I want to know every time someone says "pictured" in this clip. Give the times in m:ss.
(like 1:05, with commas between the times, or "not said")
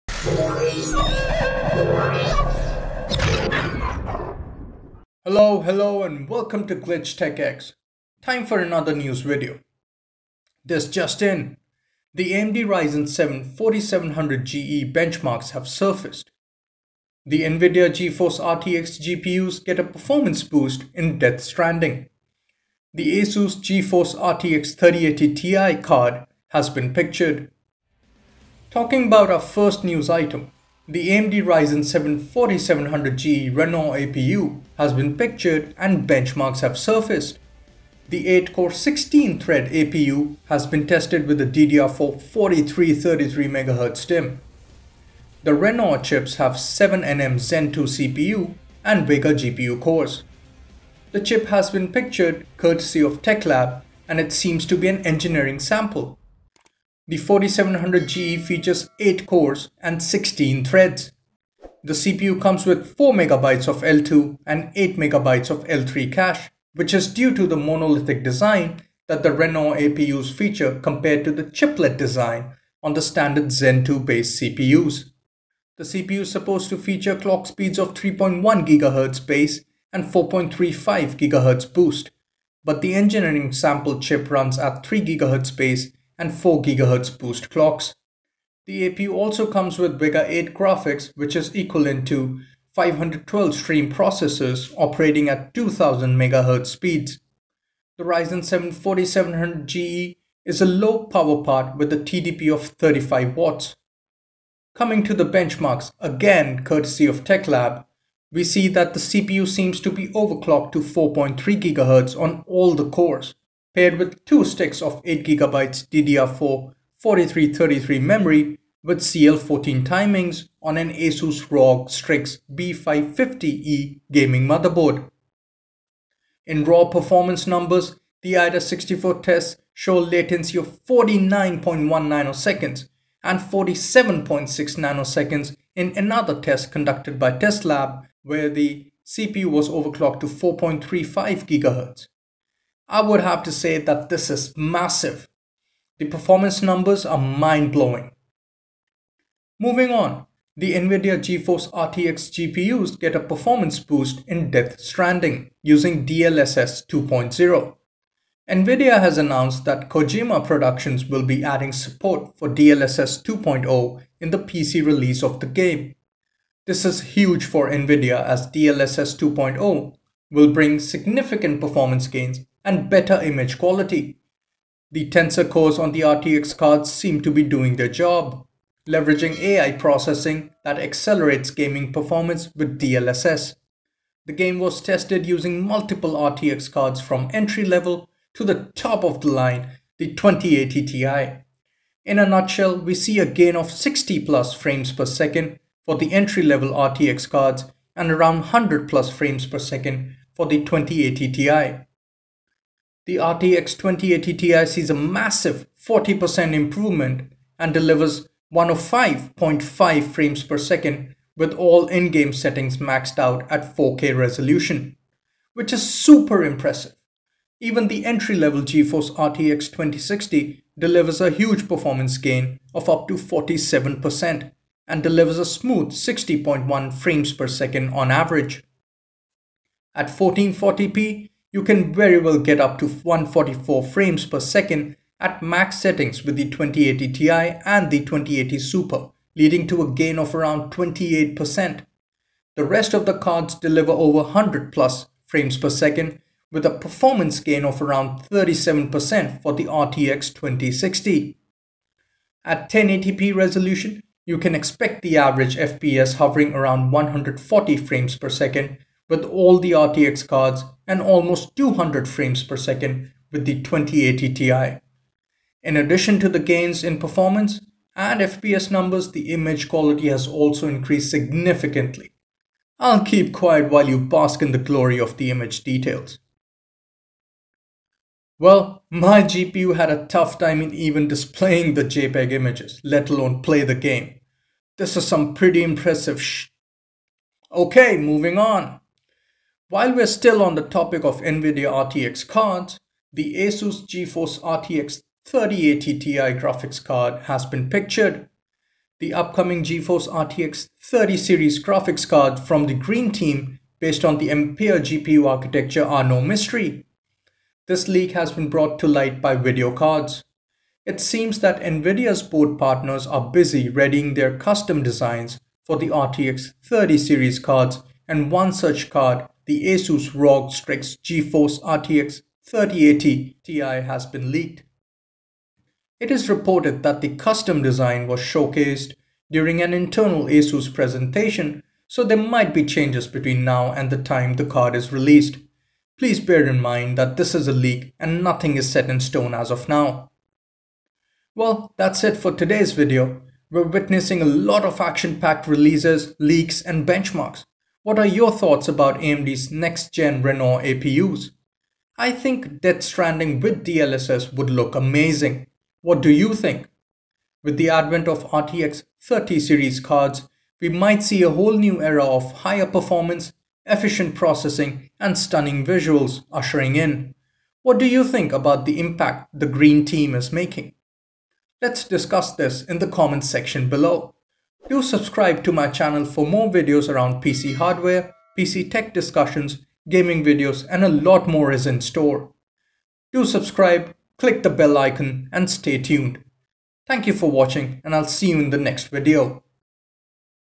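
0:26, 0:35, 0:51, 4:57.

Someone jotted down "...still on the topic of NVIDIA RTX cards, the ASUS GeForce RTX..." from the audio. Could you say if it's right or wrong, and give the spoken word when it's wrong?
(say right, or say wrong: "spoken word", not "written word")
right.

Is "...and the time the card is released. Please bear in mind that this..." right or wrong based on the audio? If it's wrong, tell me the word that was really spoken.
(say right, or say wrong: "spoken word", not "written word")
right.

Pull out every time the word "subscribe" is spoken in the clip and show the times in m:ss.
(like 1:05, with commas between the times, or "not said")
6:14, 6:23.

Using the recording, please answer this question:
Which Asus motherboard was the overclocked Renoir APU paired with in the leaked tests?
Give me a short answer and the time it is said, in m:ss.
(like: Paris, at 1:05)
Asus ROG Strix B550E, at 2:00.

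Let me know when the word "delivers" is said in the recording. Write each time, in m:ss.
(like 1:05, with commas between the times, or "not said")
3:27, 3:40, 3:45, 4:03.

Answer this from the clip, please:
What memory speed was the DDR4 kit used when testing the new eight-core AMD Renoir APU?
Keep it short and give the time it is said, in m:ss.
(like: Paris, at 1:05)
4333MHz, at 0:42.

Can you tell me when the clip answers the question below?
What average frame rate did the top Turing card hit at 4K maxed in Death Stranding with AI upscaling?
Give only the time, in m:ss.
3:28.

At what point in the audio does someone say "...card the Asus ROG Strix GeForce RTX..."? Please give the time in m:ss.
5:18.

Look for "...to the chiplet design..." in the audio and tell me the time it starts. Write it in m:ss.
1:11.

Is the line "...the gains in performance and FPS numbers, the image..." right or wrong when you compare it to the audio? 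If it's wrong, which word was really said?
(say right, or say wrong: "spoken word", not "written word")
right.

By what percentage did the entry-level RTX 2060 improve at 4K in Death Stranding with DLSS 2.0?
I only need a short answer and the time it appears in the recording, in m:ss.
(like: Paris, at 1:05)
47%, at 3:43.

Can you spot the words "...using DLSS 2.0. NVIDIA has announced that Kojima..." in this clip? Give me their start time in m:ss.
2:35.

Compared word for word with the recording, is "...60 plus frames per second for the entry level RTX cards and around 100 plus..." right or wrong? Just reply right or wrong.
right.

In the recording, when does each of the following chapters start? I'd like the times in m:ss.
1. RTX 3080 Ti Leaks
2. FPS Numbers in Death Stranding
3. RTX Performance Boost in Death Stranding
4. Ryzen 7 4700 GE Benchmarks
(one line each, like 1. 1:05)
1. 4:48
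2. 3:23
3. 2:29
4. 0:29.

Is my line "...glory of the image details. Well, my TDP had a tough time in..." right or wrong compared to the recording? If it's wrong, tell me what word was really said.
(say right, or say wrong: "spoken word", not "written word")
wrong: "GPU", not "TDP".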